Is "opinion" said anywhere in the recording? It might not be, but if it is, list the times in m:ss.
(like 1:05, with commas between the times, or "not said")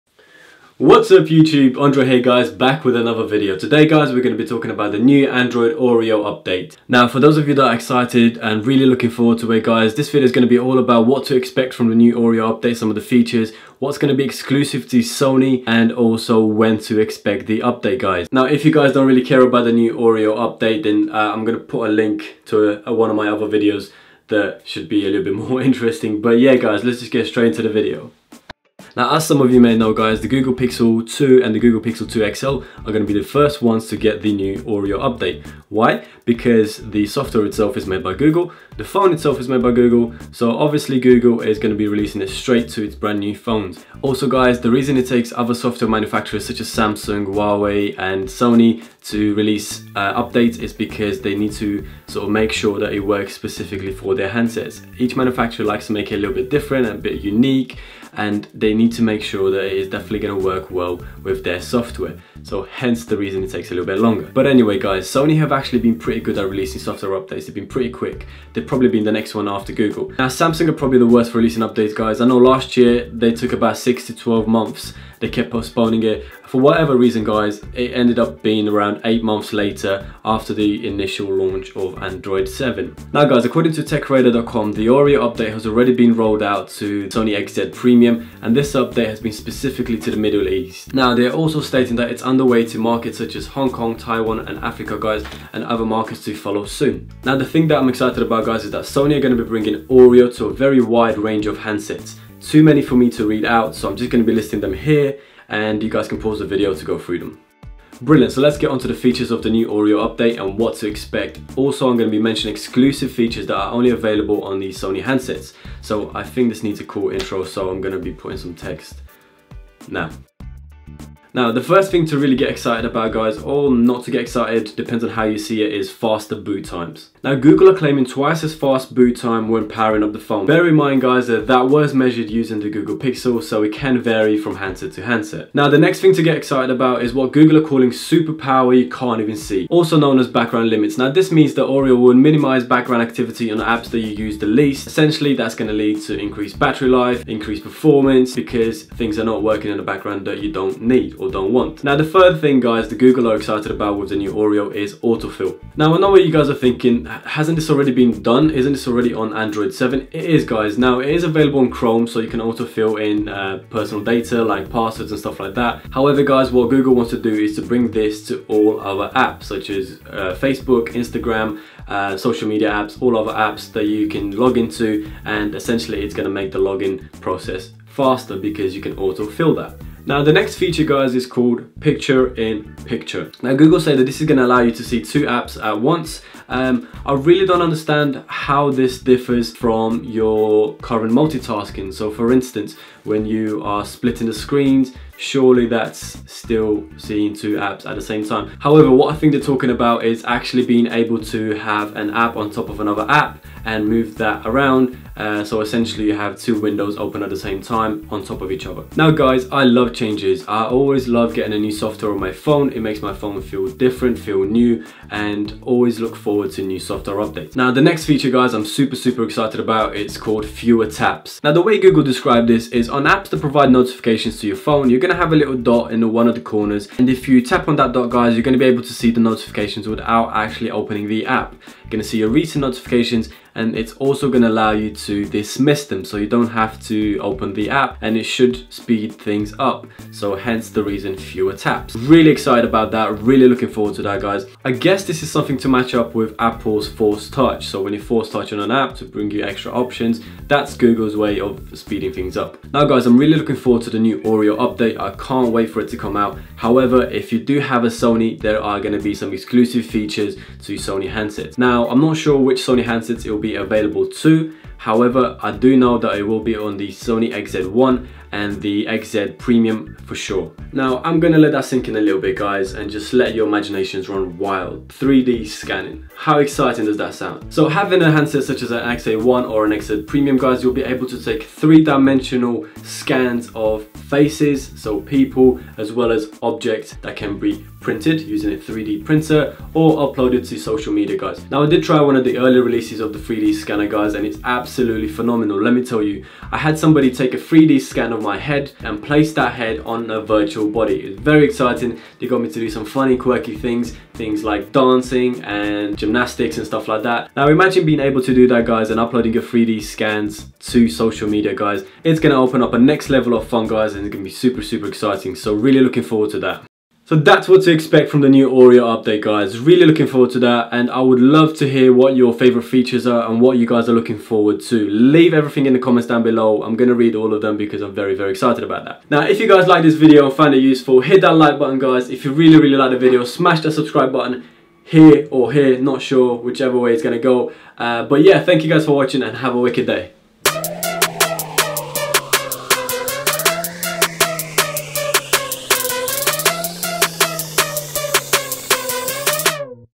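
not said.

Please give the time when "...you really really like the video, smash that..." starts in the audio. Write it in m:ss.
5:32.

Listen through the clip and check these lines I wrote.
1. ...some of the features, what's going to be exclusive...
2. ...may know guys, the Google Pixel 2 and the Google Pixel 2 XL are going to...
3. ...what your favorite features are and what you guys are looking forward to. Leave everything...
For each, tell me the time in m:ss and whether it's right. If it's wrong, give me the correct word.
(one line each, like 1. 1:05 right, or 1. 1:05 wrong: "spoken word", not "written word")
1. 0:12 right
2. 0:29 right
3. 5:21 right.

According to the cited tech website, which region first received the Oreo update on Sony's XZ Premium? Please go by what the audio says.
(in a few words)
Middle East.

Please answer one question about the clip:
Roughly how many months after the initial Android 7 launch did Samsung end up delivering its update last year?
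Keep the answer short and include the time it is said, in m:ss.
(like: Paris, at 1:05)
8 months, at 1:19.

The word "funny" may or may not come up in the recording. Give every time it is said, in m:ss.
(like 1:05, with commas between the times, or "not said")
5:02.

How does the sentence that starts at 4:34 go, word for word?
3D scanning, how exciting does that sound?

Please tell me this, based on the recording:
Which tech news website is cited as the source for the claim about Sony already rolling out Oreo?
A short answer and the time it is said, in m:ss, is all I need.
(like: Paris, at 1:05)
TechRadar.com, at 1:23.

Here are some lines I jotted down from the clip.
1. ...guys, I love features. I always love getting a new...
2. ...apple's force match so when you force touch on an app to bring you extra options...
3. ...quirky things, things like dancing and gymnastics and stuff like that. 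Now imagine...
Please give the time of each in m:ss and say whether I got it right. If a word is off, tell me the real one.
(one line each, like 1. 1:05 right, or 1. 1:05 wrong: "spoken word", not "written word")
1. 3:29 wrong: "changes", not "features"
2. 4:06 wrong: "touch", not "match"
3. 5:03 right.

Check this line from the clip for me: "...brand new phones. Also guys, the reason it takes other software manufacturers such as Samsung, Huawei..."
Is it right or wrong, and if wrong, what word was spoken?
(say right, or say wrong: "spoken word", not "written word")
right.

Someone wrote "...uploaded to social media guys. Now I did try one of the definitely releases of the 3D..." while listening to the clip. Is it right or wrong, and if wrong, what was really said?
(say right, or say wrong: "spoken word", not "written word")
wrong: "early", not "definitely".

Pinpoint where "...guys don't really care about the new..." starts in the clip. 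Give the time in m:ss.
0:18.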